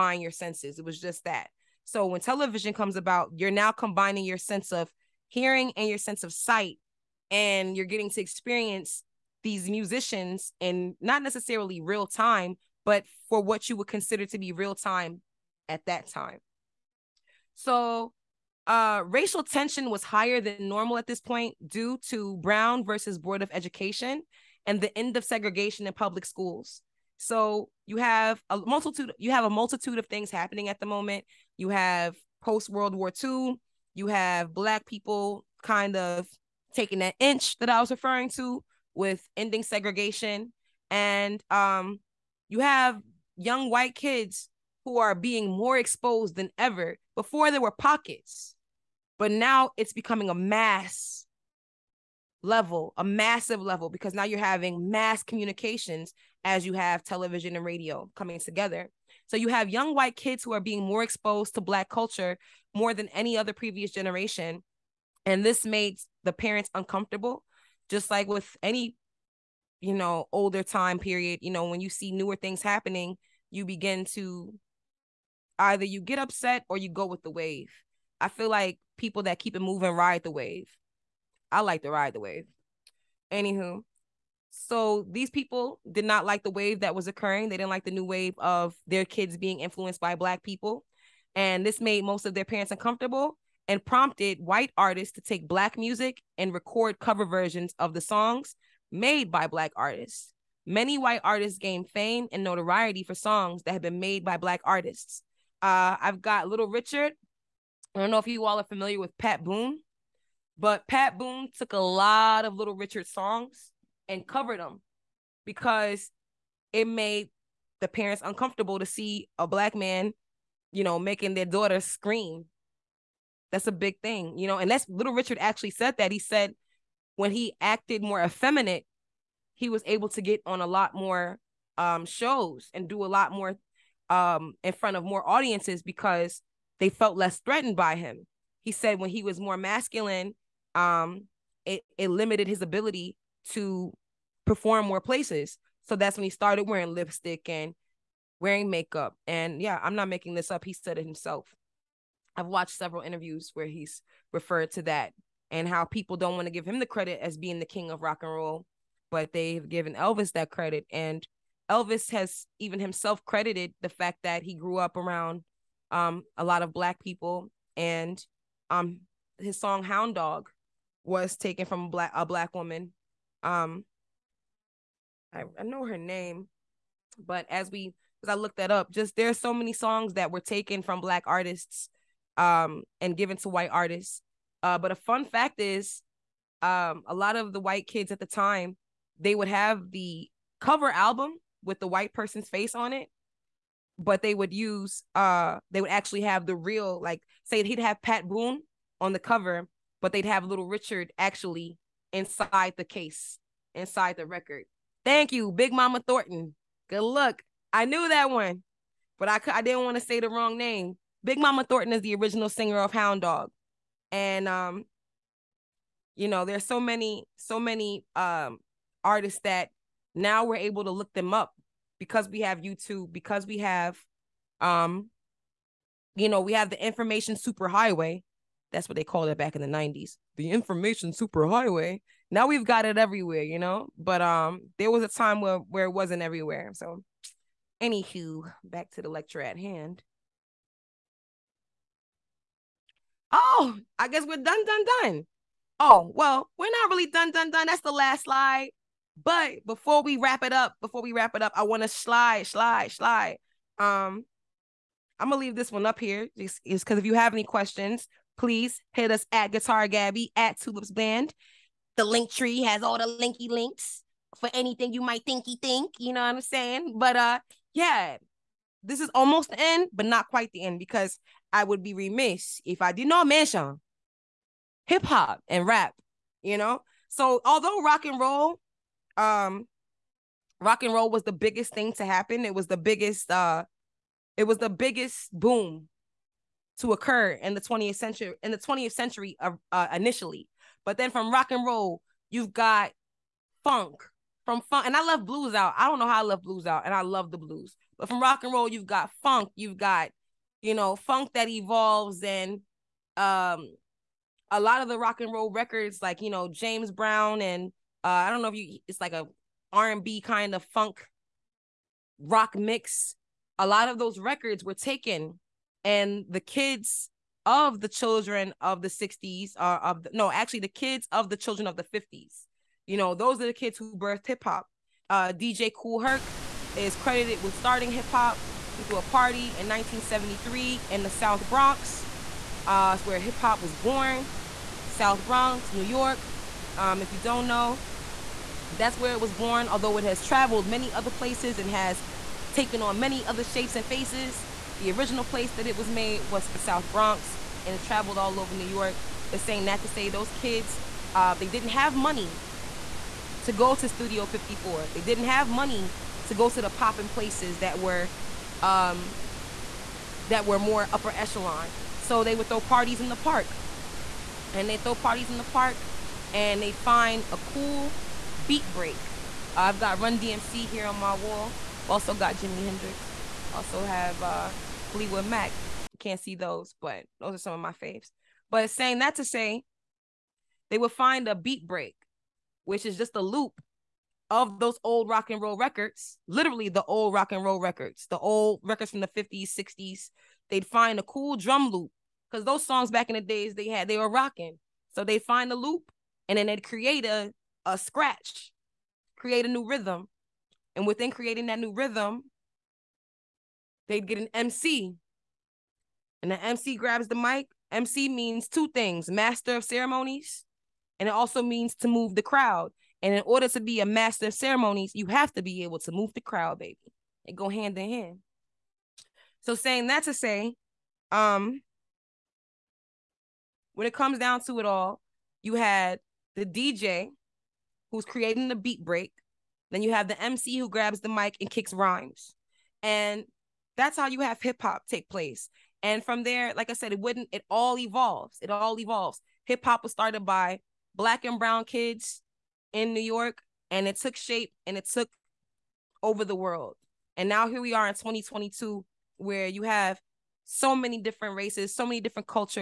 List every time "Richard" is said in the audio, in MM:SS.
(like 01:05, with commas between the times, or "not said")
01:46, 01:52, 02:05, 03:20.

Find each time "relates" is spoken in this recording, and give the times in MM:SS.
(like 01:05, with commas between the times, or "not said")
not said.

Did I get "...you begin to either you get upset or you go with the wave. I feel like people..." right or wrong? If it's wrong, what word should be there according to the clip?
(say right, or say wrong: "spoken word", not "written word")
right.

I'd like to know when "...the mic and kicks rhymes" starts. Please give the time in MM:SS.
07:11.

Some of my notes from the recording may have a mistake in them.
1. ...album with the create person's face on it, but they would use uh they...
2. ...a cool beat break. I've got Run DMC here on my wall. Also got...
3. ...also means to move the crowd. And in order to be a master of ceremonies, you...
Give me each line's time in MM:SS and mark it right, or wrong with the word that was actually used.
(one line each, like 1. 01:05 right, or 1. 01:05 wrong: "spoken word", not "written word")
1. 03:10 wrong: "white", not "create"
2. 06:07 right
3. 06:51 right.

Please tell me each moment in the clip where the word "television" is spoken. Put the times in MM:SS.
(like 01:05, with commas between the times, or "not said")
00:02, 00:57.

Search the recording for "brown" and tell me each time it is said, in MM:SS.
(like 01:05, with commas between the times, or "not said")
00:22, 05:06, 07:21.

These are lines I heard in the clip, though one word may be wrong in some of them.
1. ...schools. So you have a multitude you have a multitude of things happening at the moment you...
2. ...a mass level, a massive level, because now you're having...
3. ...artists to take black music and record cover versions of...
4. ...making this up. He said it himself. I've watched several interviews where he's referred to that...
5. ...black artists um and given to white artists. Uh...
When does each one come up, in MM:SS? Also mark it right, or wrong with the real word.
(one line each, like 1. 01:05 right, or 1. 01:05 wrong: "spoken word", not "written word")
1. 00:26 right
2. 00:50 right
3. 01:34 right
4. 02:30 right
5. 03:01 right.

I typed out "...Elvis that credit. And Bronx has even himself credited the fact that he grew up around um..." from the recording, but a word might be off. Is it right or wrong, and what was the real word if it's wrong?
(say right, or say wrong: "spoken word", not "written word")
wrong: "Elvis", not "Bronx".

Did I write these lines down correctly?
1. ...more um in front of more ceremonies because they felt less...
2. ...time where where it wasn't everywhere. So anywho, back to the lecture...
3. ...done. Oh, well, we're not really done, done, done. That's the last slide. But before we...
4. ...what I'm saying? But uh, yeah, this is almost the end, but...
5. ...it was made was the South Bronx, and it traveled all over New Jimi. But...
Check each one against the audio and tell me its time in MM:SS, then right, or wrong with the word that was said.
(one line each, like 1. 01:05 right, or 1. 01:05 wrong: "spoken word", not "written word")
1. 02:13 wrong: "audiences", not "ceremonies"
2. 03:55 right
3. 04:05 right
4. 04:26 right
5. 05:45 wrong: "York", not "Jimi".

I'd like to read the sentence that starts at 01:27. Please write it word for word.
They didn't like the new wave of their kids being influenced by black people.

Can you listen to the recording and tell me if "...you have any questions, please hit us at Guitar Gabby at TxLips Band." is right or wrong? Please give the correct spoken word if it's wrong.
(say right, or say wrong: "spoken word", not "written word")
right.